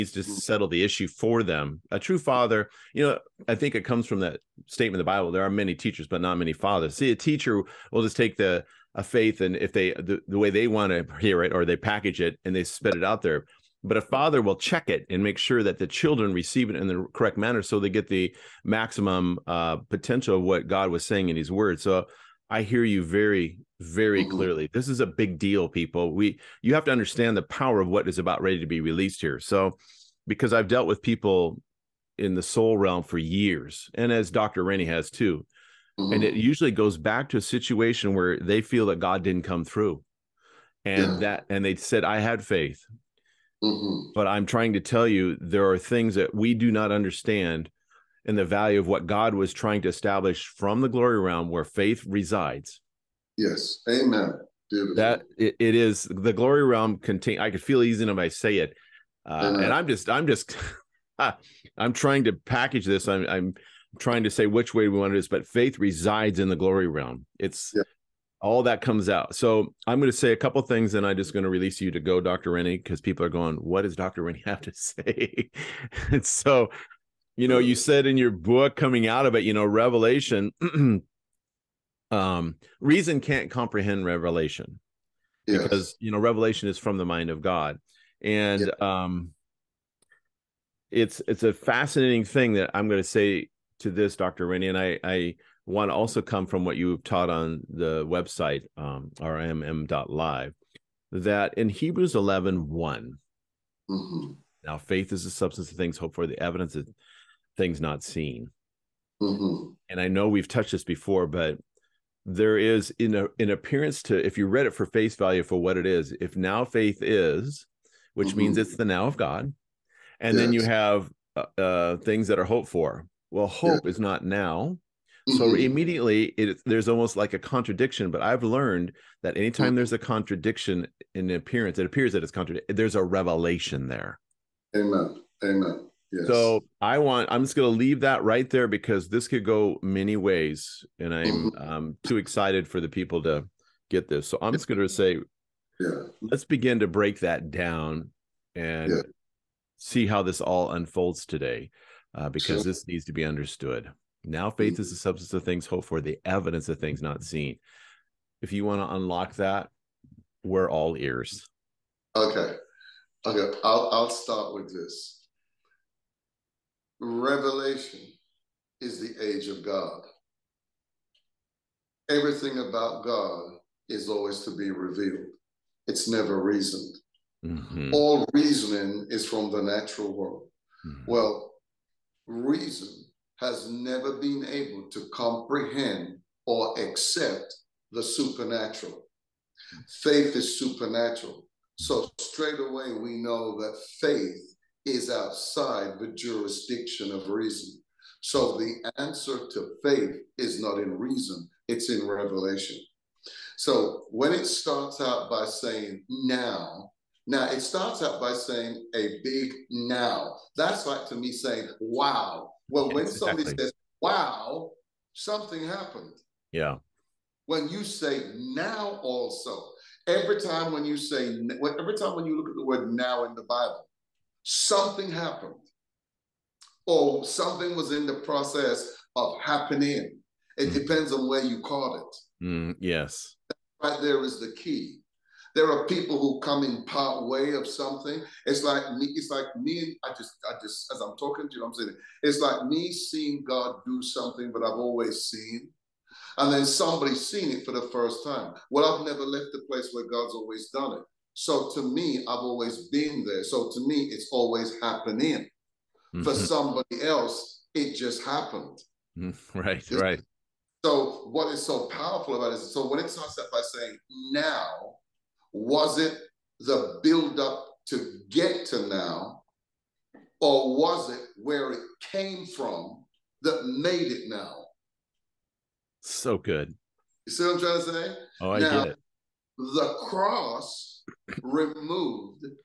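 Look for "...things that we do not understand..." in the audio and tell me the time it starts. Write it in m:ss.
0:45.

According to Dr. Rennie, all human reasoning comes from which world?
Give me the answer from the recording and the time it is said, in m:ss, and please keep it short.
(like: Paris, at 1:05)
The natural world, at 2:59.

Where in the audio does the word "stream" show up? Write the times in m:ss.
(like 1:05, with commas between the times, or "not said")
not said.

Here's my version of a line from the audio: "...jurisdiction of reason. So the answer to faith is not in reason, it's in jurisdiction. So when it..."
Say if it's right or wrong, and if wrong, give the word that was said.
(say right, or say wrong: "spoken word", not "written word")
wrong: "revelation", not "jurisdiction".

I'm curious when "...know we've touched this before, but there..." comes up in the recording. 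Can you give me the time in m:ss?
1:50.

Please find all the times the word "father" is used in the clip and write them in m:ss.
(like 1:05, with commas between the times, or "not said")
0:02, 0:06, 0:14.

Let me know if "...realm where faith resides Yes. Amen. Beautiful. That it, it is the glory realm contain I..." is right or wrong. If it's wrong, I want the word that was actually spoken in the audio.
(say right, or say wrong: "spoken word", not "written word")
right.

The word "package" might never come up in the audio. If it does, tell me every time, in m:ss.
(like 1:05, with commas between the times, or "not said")
0:11, 1:02.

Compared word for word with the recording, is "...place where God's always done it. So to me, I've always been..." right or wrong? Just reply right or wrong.
right.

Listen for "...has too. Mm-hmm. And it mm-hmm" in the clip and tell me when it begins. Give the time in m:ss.
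0:34.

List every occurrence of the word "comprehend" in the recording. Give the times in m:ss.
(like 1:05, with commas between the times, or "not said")
1:23, 3:05.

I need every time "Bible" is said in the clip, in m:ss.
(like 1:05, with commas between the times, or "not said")
0:05, 3:43.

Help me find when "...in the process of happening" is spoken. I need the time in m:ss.
3:47.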